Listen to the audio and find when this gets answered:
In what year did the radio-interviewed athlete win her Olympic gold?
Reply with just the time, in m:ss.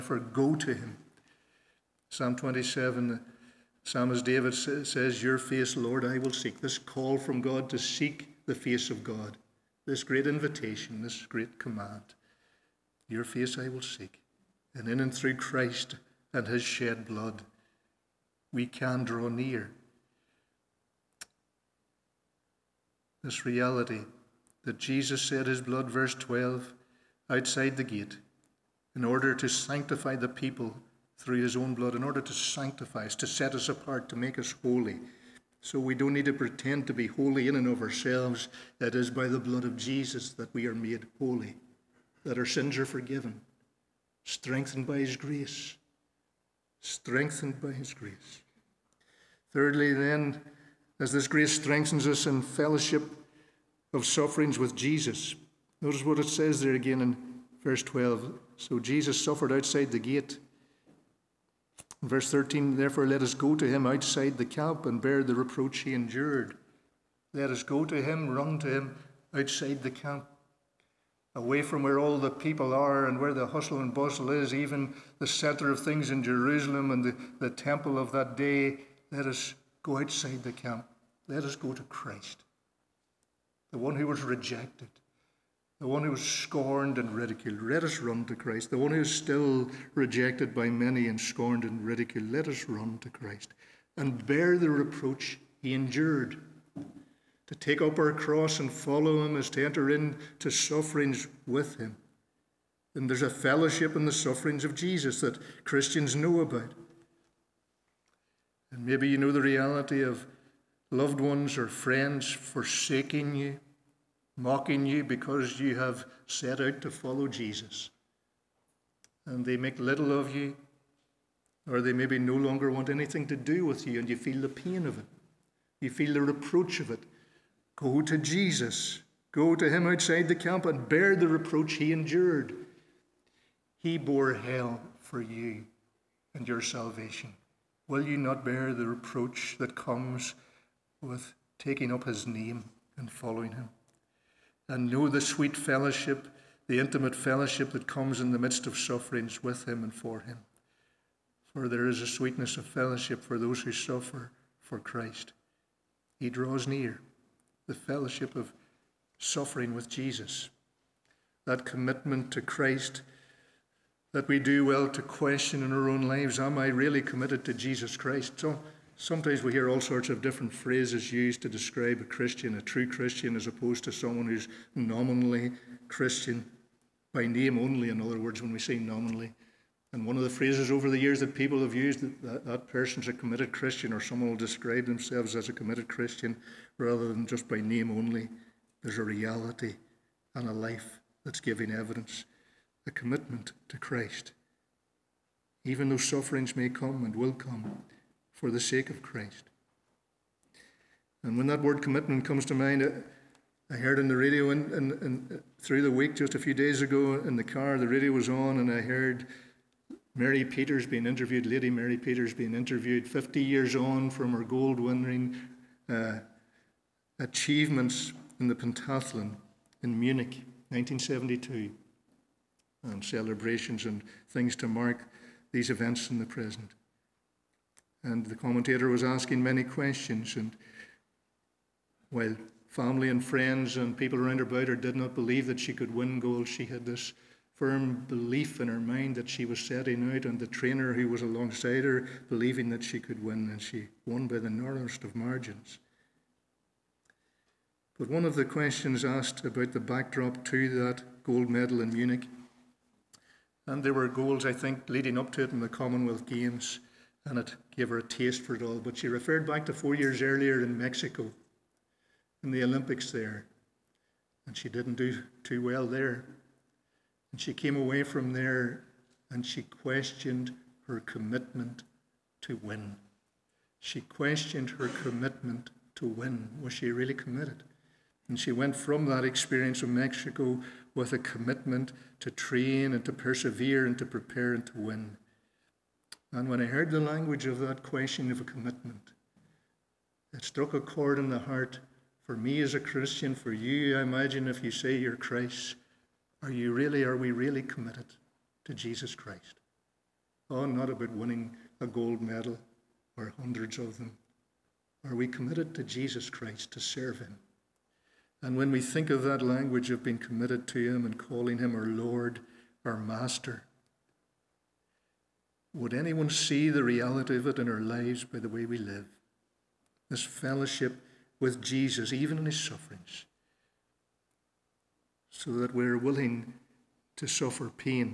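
3:40.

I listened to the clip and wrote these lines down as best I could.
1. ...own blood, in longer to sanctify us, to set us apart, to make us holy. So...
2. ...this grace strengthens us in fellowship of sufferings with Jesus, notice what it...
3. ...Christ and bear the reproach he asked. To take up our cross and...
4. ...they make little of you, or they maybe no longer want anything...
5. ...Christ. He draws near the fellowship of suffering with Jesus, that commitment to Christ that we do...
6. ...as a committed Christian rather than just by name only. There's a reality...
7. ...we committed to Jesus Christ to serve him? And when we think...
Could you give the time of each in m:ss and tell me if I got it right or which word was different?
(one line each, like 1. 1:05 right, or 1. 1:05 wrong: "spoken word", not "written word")
1. 0:31 wrong: "order", not "longer"
2. 0:51 right
3. 1:33 wrong: "endured", not "asked"
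4. 1:59 right
5. 2:34 right
6. 3:05 right
7. 5:05 right.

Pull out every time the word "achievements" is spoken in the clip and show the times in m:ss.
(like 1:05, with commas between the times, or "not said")
3:37.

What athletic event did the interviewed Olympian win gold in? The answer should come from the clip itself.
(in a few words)
Pentathlon.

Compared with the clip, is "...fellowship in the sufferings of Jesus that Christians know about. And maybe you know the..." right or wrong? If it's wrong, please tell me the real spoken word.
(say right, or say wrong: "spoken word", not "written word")
right.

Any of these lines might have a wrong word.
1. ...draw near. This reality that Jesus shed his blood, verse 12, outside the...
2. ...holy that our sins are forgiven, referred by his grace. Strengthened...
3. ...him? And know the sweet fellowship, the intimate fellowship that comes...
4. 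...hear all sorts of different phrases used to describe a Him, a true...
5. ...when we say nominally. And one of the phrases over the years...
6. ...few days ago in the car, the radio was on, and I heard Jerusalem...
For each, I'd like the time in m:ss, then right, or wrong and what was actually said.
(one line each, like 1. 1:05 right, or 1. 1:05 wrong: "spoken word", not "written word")
1. 0:19 right
2. 0:41 wrong: "strengthened", not "referred"
3. 2:23 right
4. 2:49 wrong: "Christian", not "Him"
5. 2:58 right
6. 3:26 wrong: "Mary", not "Jerusalem".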